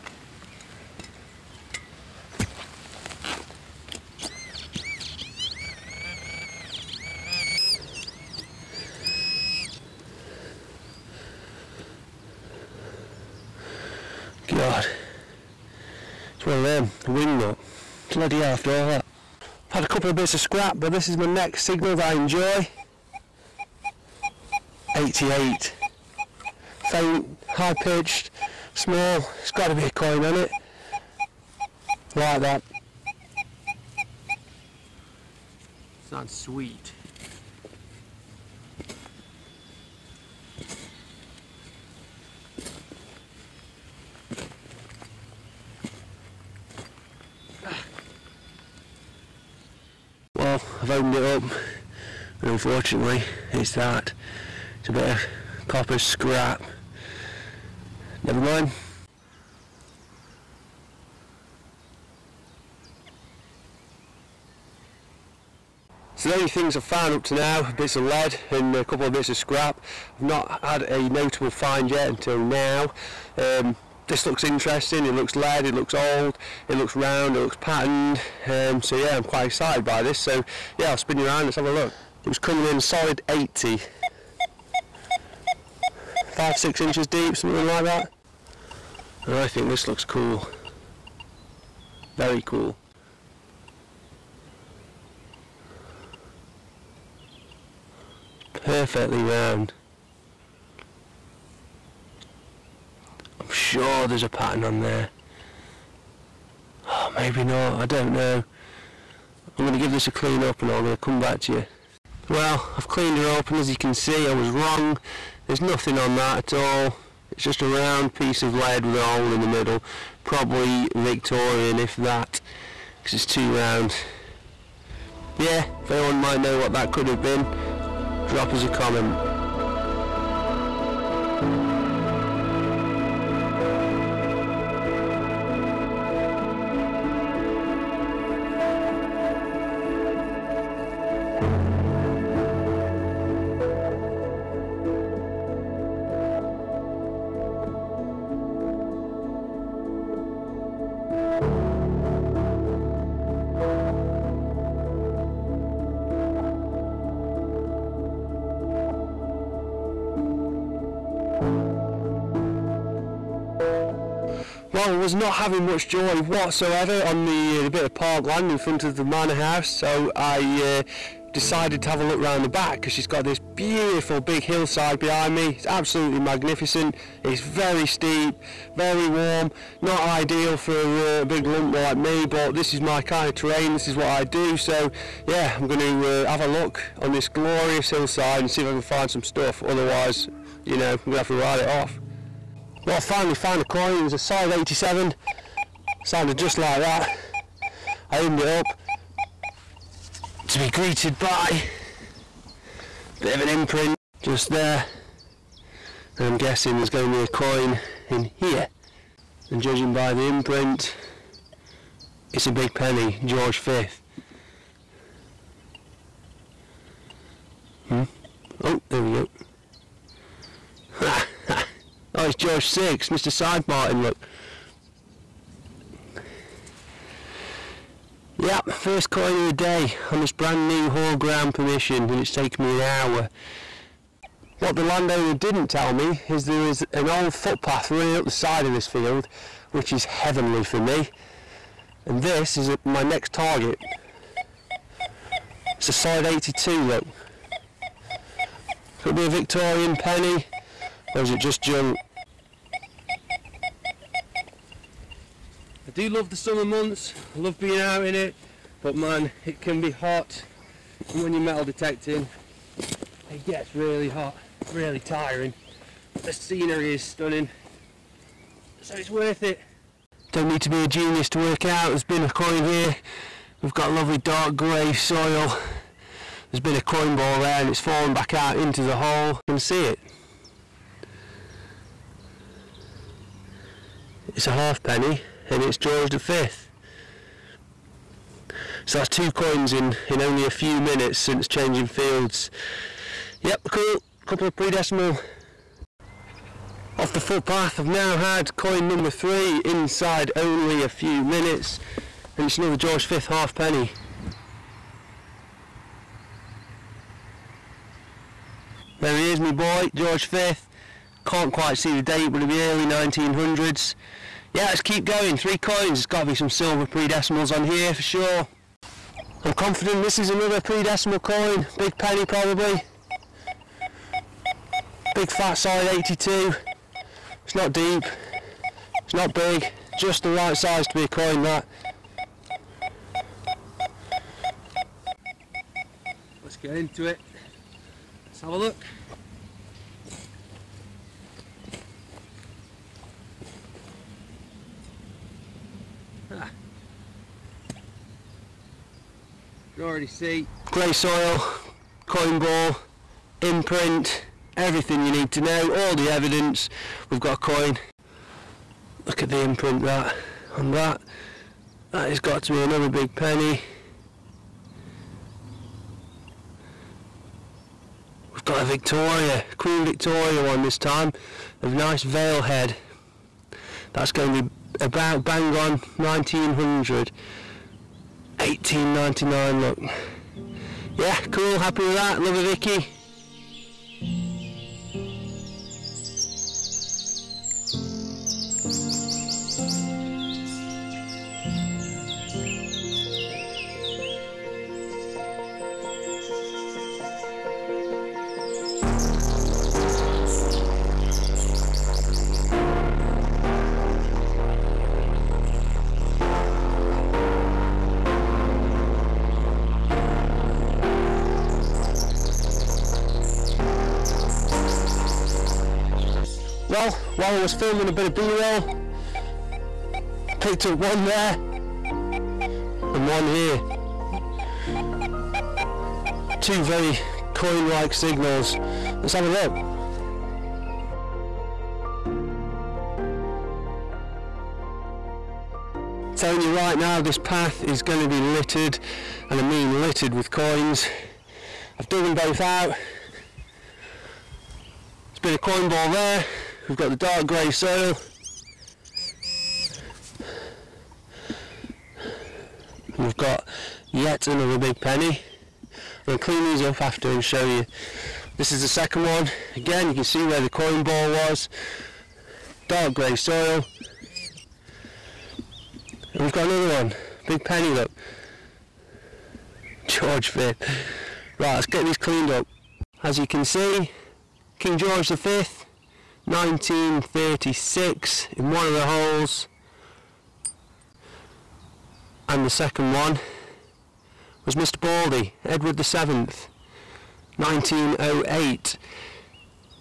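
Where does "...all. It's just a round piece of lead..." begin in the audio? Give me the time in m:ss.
1:56.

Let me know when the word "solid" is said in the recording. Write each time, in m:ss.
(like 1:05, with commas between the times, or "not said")
1:22, 3:14, 4:05, 5:25.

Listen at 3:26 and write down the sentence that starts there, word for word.
And I'm guessing there's going to be a coin in here.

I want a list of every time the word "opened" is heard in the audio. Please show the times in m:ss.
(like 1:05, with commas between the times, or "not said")
0:50, 3:18.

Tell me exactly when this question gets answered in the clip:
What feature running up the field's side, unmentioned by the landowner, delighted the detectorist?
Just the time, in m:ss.
3:57.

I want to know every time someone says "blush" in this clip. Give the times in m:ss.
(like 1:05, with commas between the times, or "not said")
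not said.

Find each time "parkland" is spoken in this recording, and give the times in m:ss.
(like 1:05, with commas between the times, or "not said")
2:47.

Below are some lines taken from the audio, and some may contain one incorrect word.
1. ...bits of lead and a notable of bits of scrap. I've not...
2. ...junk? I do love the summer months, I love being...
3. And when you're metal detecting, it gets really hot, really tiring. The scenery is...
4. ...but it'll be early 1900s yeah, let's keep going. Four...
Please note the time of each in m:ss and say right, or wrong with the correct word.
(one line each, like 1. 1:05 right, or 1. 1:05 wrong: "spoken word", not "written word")
1. 1:07 wrong: "couple", not "notable"
2. 4:11 right
3. 4:21 right
4. 5:12 wrong: "Three", not "Four".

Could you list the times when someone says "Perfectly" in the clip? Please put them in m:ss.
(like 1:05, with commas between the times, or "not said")
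1:38.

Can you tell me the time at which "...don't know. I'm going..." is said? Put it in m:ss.
1:47.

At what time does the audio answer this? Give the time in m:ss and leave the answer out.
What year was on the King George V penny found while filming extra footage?
7:56.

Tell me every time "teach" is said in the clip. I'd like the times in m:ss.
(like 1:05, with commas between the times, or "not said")
not said.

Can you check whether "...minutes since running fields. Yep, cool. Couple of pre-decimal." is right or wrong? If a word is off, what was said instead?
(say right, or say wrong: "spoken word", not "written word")
wrong: "changing", not "running".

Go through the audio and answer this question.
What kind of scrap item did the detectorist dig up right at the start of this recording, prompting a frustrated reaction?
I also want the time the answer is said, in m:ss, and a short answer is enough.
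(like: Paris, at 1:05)
wing nut, at 0:17.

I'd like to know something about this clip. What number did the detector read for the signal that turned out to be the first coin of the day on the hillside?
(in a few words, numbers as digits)
87.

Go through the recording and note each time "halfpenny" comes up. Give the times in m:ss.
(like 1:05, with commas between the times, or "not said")
4:44, 5:03.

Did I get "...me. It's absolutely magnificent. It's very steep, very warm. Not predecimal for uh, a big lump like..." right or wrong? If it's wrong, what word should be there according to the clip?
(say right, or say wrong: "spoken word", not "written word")
wrong: "ideal", not "predecimal".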